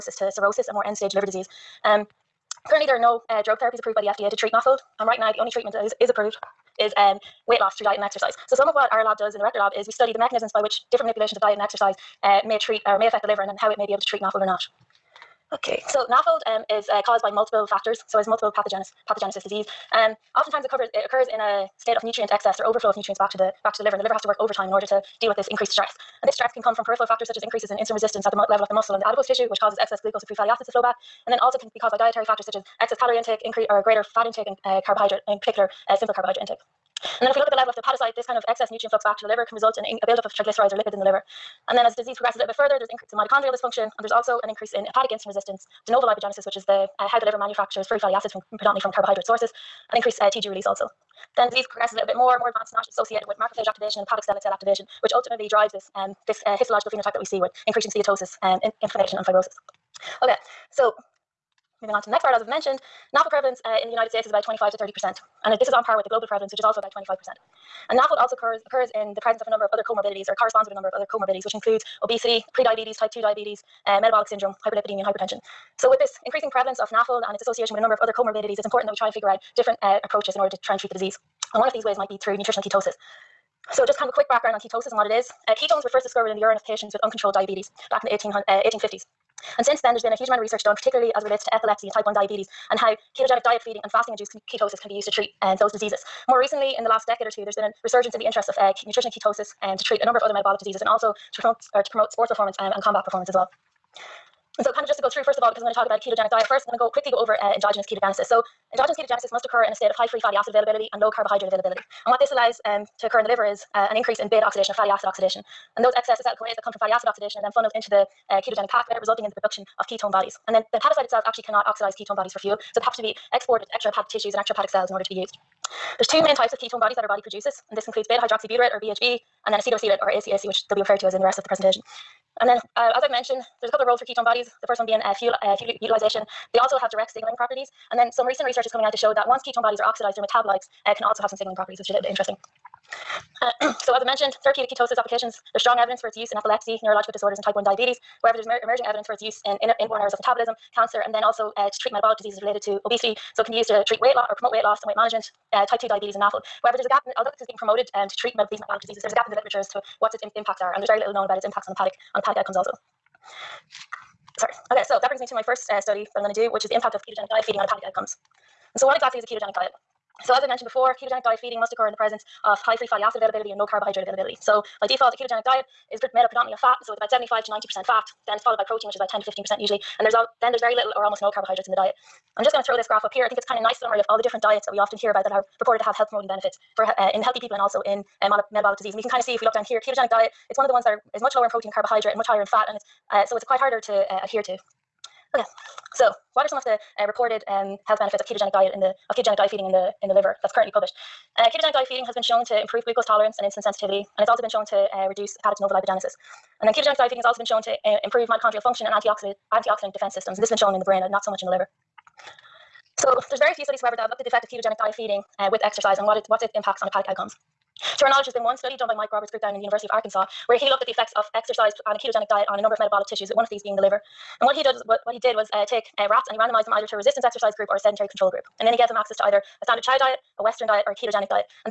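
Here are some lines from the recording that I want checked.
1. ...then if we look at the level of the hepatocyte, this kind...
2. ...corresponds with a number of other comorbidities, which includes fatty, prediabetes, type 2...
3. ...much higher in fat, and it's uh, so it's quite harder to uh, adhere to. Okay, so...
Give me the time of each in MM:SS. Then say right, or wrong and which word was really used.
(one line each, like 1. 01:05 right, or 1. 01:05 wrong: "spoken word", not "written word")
1. 00:37 right
2. 01:10 wrong: "obesity", not "fatty"
3. 03:12 right.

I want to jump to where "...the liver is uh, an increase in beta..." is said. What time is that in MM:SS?
01:53.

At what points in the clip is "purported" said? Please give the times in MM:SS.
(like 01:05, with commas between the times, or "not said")
03:05.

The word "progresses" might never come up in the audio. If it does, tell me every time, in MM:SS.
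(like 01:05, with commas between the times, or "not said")
00:42, 00:51.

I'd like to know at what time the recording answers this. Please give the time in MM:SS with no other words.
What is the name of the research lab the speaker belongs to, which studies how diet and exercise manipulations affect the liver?
00:09.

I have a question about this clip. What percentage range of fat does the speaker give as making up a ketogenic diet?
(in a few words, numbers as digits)
75 to 90%.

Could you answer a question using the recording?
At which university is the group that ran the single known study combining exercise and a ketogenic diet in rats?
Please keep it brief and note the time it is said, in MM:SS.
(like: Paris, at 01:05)
University of Arkansas, at 03:39.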